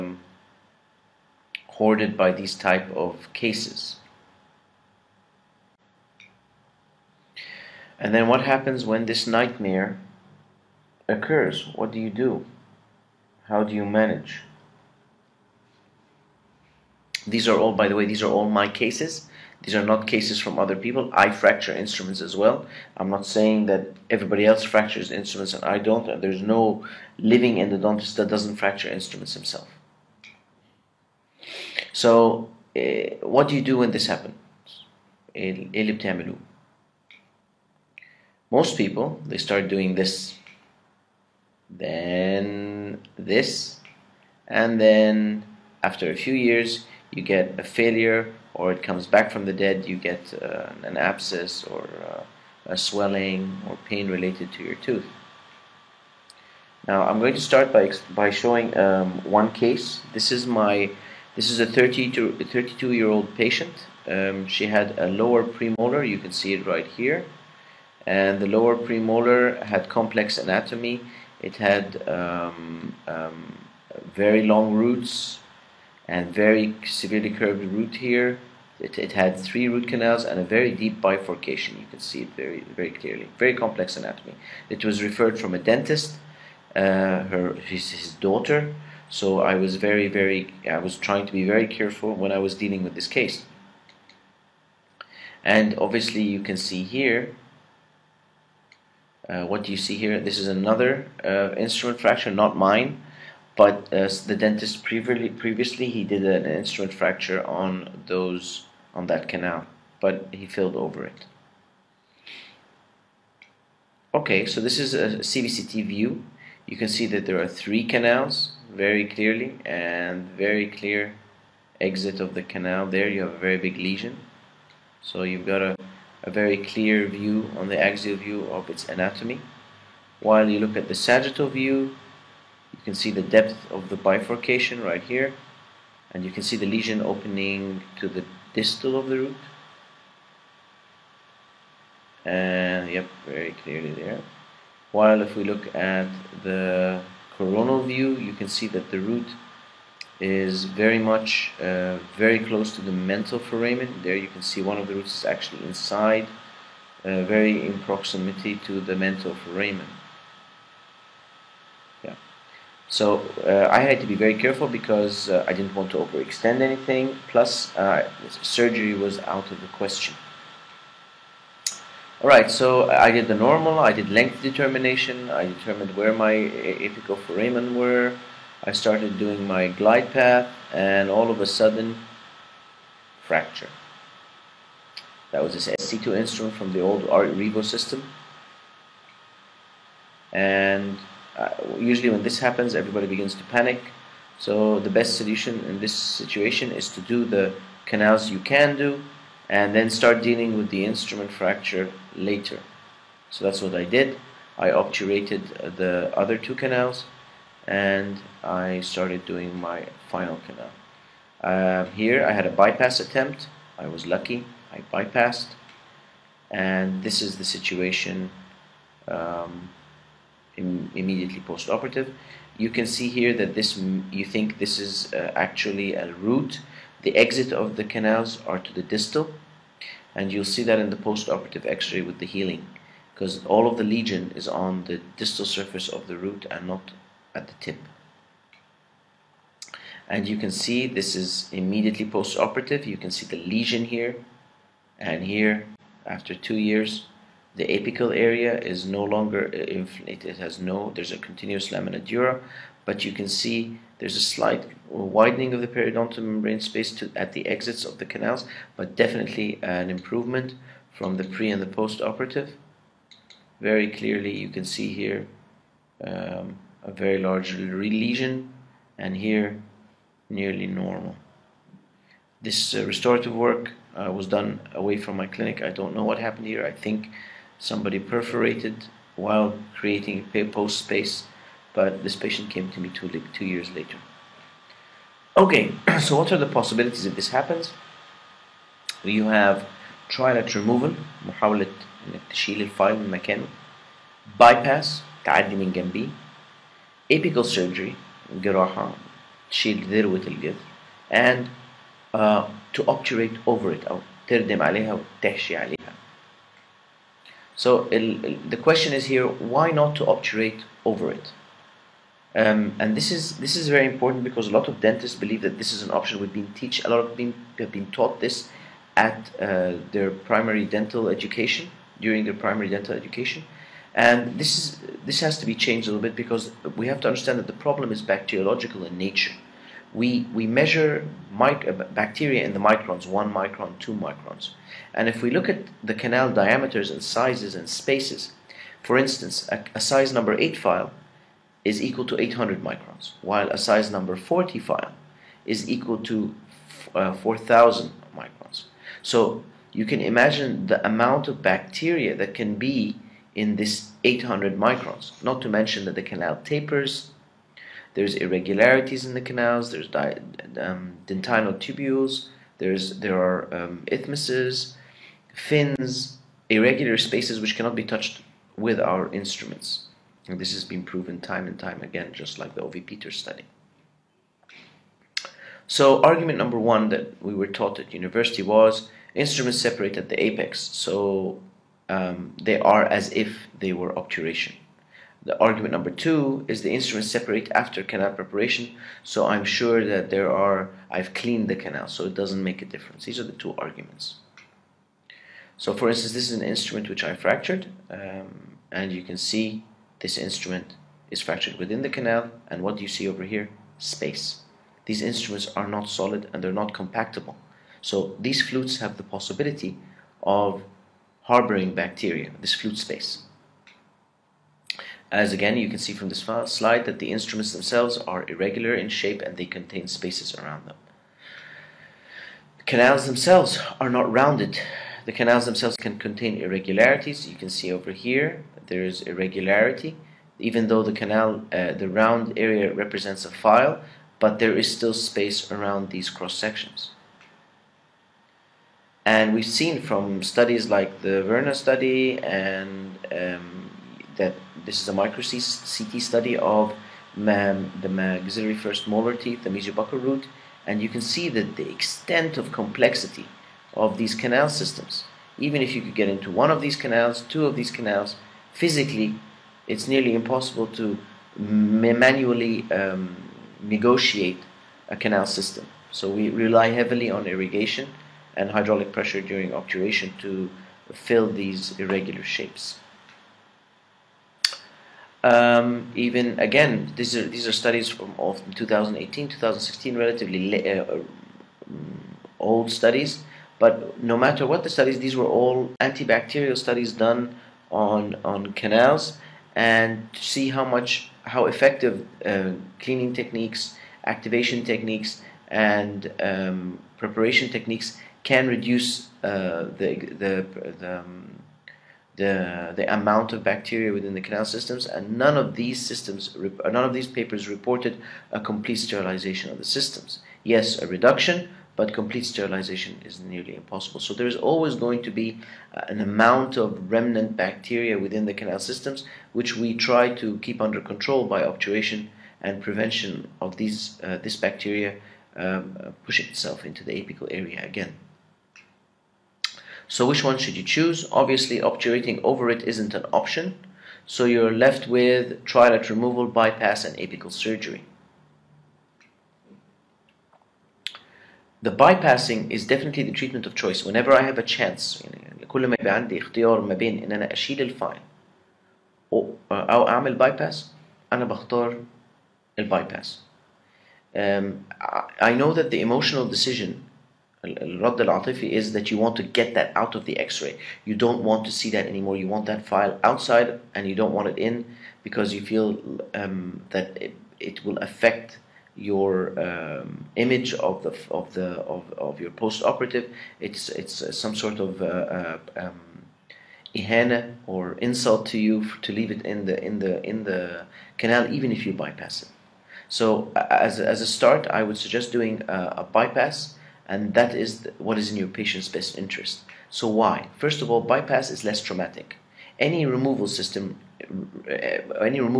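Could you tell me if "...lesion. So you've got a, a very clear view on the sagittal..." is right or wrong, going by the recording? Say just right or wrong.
wrong.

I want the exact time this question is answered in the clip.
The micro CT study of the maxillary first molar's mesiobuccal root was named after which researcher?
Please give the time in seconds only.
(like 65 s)
441 s.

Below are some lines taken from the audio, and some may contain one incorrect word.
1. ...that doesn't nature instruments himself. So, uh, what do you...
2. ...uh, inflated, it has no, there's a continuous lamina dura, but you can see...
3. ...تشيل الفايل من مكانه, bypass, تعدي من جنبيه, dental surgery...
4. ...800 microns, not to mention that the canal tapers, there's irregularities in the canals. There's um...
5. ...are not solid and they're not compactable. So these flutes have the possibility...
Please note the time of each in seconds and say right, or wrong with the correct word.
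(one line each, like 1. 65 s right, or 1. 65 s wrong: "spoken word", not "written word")
1. 28 s wrong: "fracture", not "nature"
2. 249 s right
3. 292 s wrong: "apical", not "dental"
4. 354 s right
5. 405 s right.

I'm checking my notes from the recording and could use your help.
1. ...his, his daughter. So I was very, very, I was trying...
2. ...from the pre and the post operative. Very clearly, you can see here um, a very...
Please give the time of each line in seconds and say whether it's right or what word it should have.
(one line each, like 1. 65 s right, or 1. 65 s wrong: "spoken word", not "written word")
1. 87 s right
2. 260 s right.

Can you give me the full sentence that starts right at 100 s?
This is another uh, instrument fracture, not mine.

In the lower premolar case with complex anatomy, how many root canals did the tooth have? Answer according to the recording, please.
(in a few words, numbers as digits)
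3.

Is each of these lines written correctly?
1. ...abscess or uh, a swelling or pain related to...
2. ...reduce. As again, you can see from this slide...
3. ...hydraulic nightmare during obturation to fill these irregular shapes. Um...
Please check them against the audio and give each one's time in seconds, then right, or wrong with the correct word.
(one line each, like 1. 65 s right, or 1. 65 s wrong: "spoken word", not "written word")
1. 50 s right
2. 412 s wrong: "space", not "reduce"
3. 468 s wrong: "pressure", not "nightmare".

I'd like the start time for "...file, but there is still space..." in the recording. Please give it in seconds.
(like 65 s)
433 s.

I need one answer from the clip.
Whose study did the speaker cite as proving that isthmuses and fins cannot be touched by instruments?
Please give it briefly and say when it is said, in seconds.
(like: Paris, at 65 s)
Ove Peters, at 372 s.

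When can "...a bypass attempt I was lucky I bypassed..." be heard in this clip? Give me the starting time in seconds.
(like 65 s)
212 s.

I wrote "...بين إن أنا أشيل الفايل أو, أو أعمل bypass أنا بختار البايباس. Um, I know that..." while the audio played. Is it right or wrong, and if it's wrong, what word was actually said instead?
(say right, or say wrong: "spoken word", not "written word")
right.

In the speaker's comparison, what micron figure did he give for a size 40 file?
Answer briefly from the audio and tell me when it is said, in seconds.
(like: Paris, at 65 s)
4,000 microns, at 347 s.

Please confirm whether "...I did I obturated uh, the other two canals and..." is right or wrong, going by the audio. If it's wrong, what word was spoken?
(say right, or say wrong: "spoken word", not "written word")
right.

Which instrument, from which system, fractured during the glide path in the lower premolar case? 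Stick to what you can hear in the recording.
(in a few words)
SC2 from the old Revo system.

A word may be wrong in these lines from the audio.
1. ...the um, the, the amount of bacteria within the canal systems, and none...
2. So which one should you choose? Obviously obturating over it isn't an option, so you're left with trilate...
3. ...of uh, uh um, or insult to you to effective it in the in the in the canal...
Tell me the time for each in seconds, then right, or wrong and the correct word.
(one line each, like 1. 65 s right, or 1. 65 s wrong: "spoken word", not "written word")
1. 500 s right
2. 529 s right
3. 574 s wrong: "leave", not "effective".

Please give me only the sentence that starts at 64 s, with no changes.
Um, she had a lower premolar.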